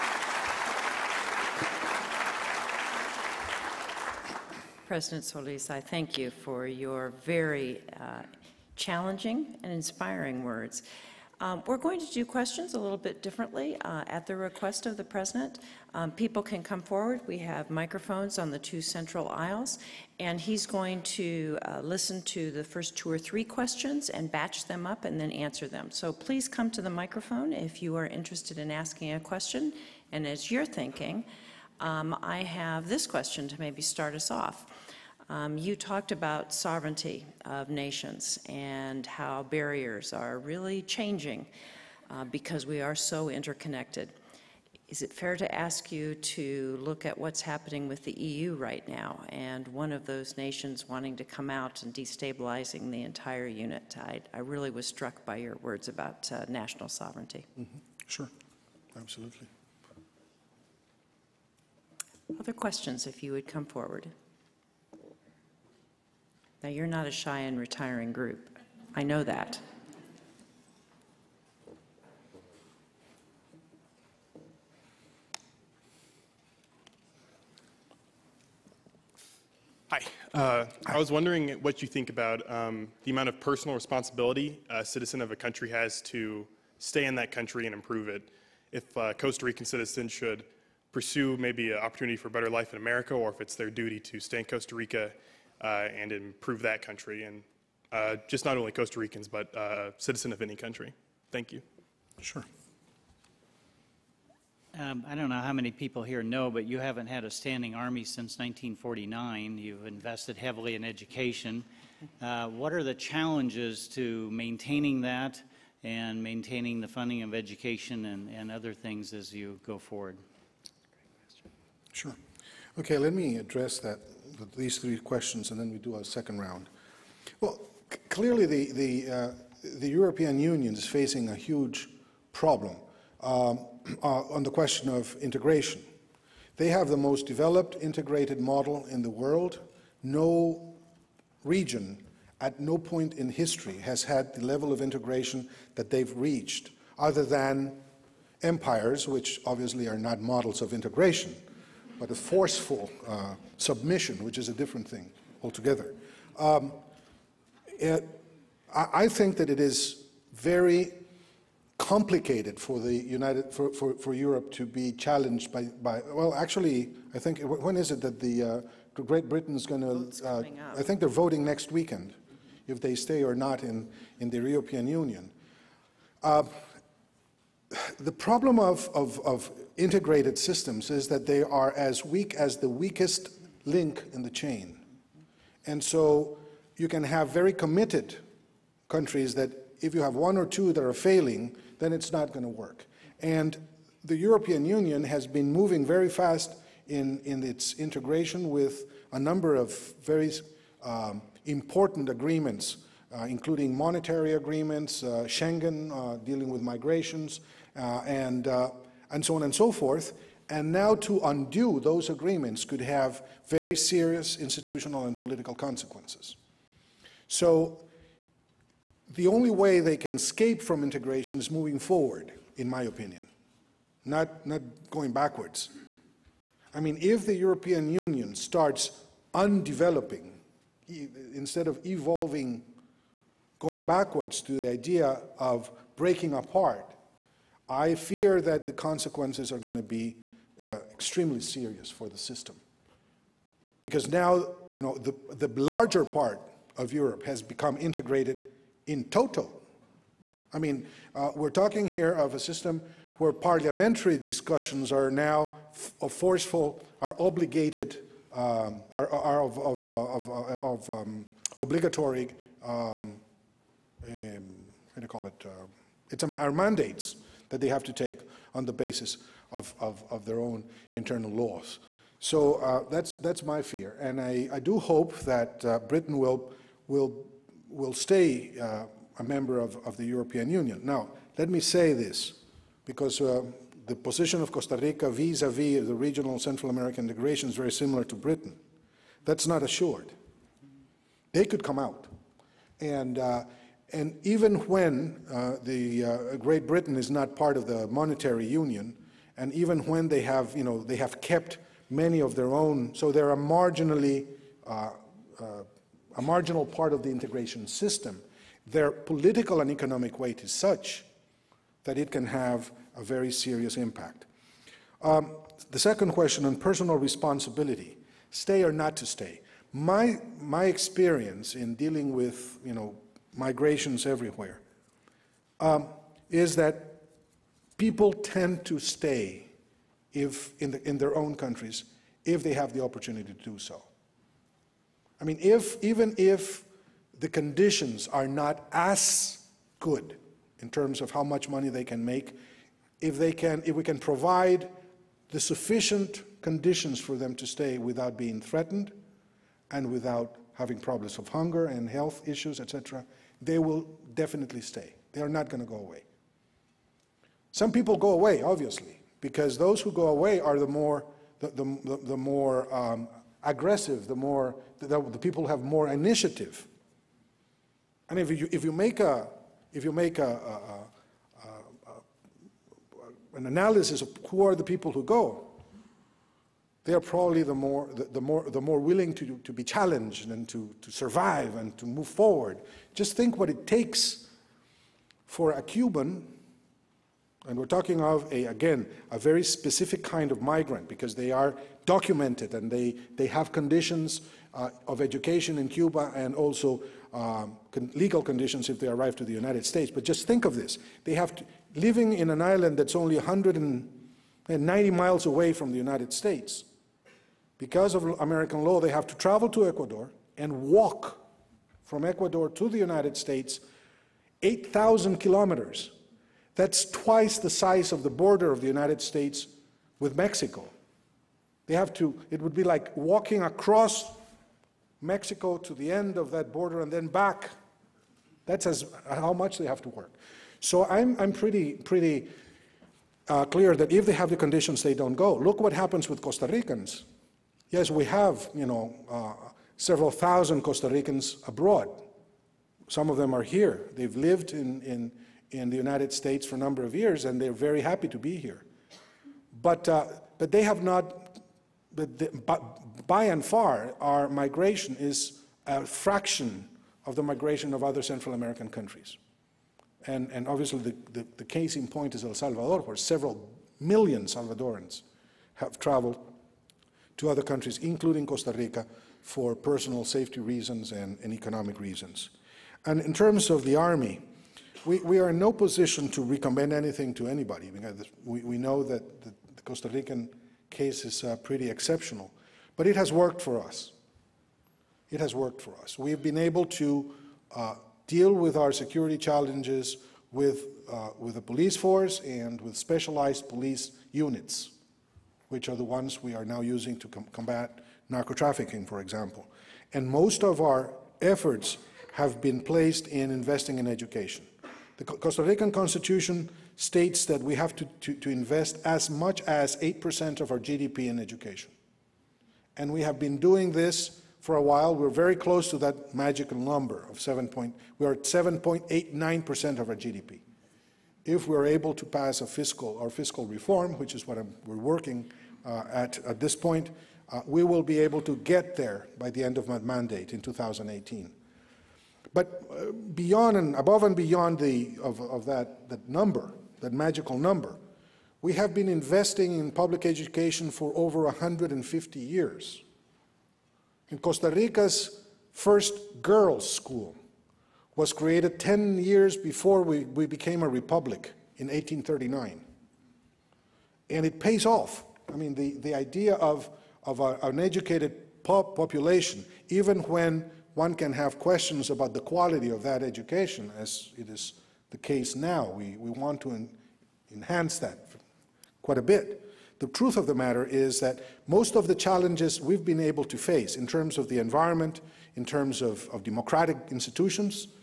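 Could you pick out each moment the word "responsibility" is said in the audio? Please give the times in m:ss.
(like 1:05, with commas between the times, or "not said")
1:23, 5:16.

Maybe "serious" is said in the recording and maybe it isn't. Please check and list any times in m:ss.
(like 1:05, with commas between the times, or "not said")
3:33, 4:01, 5:13.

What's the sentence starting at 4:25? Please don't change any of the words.
Uh, it's um, our mandates that they have to take on the basis of, of, of their own internal laws.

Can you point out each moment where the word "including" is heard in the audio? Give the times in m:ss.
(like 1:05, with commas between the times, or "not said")
3:23, 7:47.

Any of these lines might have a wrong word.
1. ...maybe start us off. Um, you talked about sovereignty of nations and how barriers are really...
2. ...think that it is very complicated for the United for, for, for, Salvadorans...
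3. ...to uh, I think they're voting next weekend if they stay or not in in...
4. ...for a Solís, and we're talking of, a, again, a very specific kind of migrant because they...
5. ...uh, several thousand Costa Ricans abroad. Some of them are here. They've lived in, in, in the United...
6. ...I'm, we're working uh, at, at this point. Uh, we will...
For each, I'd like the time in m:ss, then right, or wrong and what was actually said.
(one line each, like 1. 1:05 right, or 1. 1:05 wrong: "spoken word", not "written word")
1. 0:33 right
2. 2:39 wrong: "Europe", not "Salvadorans"
3. 2:49 right
4. 6:25 wrong: "Cuban", not "Solís"
5. 7:19 right
6. 8:44 right.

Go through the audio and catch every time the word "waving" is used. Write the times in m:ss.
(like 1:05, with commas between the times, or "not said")
not said.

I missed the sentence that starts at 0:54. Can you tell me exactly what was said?
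I, I really was struck by your words about uh, national sovereignty.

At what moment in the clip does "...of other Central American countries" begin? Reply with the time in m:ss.
7:37.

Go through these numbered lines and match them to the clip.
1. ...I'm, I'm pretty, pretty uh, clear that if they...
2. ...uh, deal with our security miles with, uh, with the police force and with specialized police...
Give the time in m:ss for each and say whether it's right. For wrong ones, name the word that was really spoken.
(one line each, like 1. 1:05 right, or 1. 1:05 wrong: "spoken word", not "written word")
1. 7:10 right
2. 8:07 wrong: "challenges", not "miles".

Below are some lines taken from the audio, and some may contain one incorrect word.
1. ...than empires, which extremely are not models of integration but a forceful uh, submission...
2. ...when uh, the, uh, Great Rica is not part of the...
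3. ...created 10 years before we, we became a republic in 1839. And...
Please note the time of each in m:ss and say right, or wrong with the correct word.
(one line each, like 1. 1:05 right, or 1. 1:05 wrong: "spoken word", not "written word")
1. 2:27 wrong: "obviously", not "extremely"
2. 4:54 wrong: "Britain", not "Rica"
3. 9:08 right.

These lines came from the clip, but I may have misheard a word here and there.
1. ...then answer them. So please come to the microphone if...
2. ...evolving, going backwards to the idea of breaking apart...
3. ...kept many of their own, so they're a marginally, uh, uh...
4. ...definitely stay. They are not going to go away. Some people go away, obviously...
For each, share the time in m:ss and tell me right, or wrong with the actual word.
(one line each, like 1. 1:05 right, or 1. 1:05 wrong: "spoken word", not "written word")
1. 0:25 right
2. 3:51 right
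3. 5:01 right
4. 5:54 right.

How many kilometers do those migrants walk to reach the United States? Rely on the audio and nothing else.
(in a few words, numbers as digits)
8,000.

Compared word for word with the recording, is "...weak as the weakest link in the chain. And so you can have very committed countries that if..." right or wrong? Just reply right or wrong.
right.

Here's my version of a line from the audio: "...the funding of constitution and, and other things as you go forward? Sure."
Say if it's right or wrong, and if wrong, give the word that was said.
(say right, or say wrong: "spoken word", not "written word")
wrong: "education", not "constitution".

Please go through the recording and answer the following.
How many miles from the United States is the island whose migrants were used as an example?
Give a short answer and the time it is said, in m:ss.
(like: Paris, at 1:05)
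190, at 6:43.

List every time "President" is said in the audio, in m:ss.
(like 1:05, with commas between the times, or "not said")
0:04, 0:15.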